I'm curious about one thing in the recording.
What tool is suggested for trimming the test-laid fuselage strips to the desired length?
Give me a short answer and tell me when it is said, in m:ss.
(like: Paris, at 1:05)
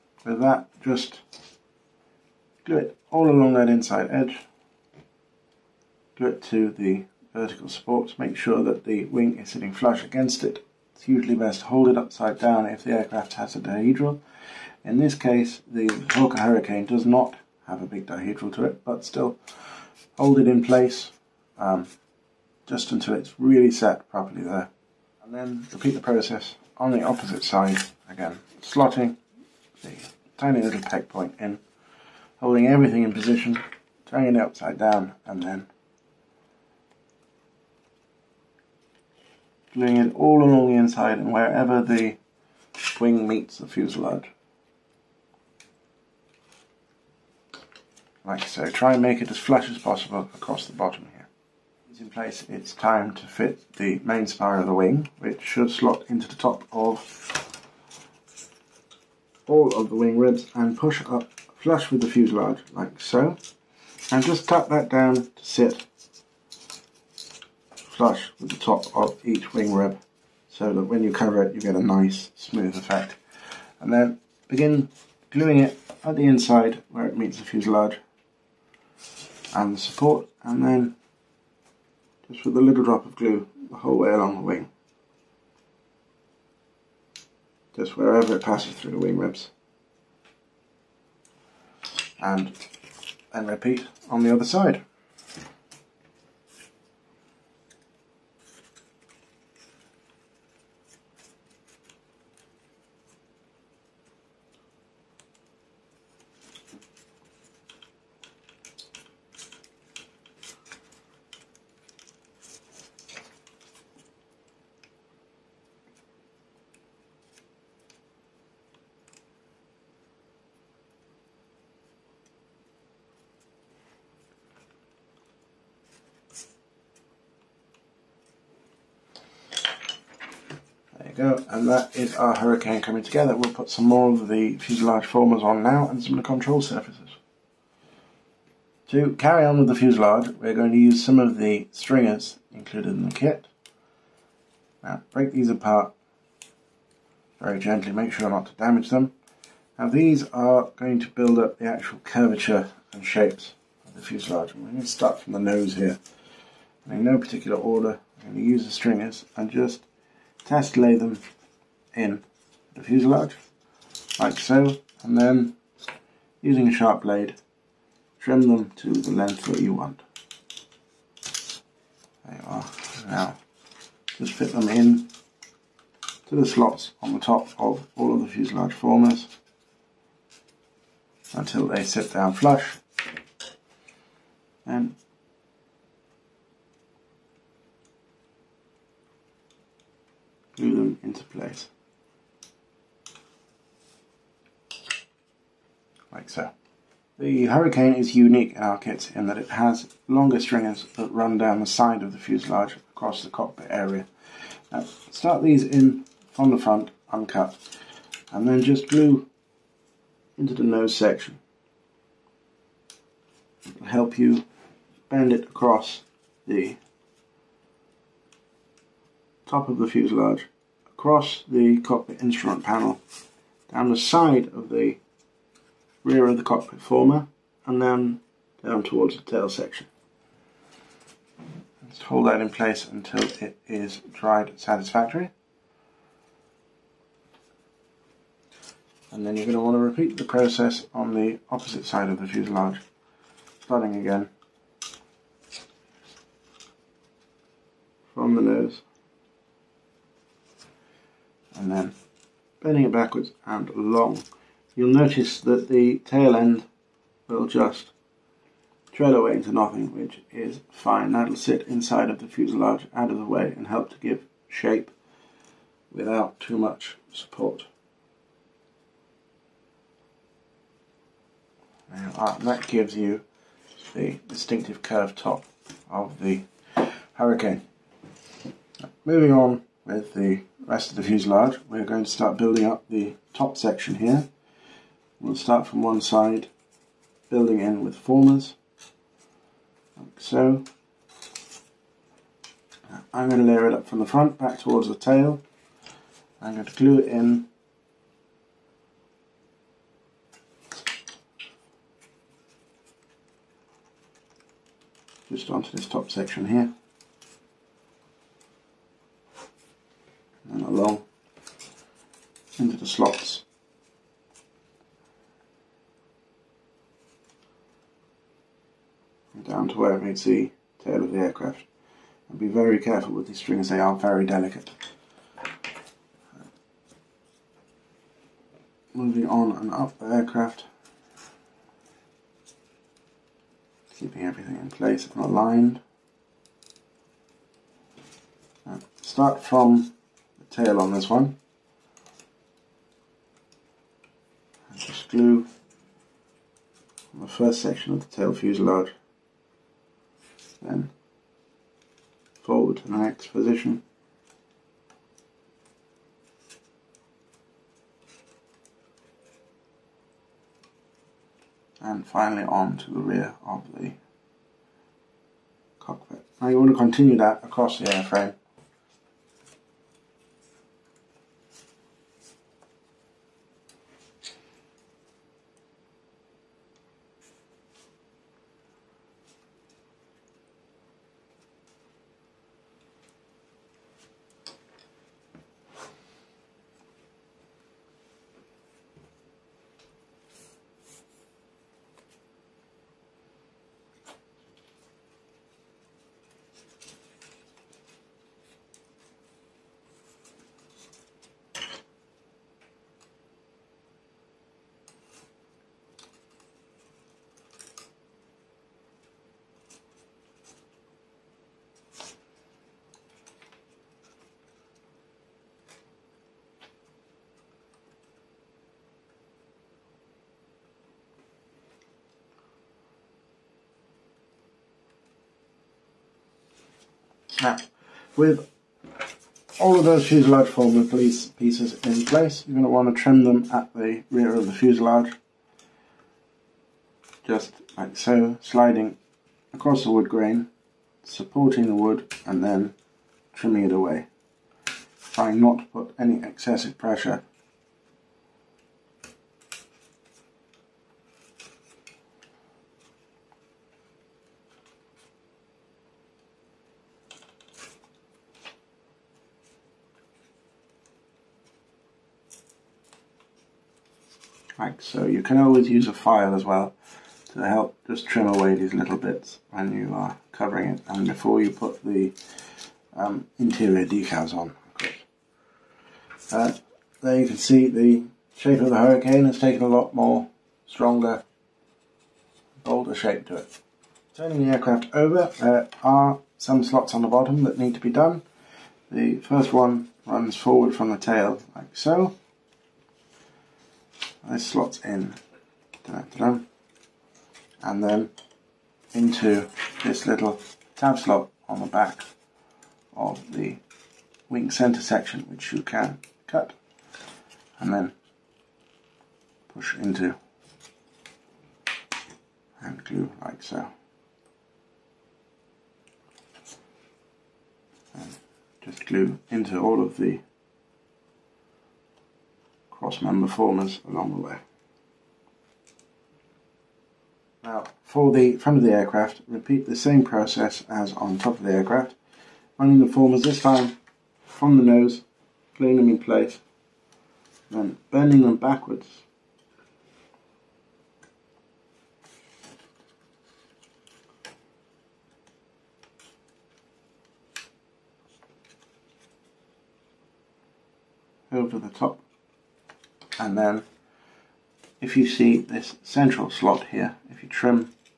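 A sharp blade, at 2:46.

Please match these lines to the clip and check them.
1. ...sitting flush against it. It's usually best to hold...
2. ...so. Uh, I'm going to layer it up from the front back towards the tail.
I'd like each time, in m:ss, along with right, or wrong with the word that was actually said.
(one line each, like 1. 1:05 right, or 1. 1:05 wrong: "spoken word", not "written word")
1. 0:09 right
2. 4:50 right.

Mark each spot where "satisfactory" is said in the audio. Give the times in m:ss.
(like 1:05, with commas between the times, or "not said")
3:54.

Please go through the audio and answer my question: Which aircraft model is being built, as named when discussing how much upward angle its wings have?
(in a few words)
Hawker Hurricane.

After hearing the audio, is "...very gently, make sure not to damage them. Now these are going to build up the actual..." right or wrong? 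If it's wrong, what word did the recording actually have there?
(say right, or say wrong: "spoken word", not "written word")
right.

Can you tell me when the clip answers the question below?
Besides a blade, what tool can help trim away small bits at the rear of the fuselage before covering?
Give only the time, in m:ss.
7:45.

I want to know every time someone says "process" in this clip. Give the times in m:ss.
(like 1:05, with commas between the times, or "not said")
0:25, 4:00, 8:50.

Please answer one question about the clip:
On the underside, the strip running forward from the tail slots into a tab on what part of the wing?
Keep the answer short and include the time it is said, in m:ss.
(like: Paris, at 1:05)
Center section, at 8:24.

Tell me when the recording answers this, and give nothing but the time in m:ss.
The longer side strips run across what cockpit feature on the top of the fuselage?
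3:42.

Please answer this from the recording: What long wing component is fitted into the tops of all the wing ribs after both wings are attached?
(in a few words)
Main spar.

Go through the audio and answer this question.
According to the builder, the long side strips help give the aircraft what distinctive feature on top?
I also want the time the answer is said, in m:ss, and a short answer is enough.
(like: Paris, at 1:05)
Curved top, at 4:34.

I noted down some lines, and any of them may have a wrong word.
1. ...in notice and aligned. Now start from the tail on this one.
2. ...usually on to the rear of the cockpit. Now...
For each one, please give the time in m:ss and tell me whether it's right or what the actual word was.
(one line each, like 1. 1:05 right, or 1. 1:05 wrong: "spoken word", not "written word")
1. 5:34 wrong: "place", not "notice"
2. 6:02 wrong: "finally", not "usually".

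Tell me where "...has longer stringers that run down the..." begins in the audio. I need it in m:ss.
3:19.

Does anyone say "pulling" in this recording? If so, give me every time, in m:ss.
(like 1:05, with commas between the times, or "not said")
8:55.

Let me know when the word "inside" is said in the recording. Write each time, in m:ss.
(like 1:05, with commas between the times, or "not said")
0:03, 0:40, 1:16, 4:21.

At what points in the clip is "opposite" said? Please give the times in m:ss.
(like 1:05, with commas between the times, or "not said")
0:27, 4:01.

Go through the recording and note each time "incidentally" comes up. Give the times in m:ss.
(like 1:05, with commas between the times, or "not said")
not said.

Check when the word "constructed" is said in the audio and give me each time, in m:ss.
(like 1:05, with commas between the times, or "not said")
not said.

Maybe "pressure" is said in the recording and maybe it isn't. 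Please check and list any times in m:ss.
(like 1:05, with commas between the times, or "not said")
7:26.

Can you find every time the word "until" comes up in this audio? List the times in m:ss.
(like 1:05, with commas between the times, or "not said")
0:22, 3:01, 3:52.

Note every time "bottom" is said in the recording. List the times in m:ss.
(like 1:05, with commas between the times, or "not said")
0:50, 8:07.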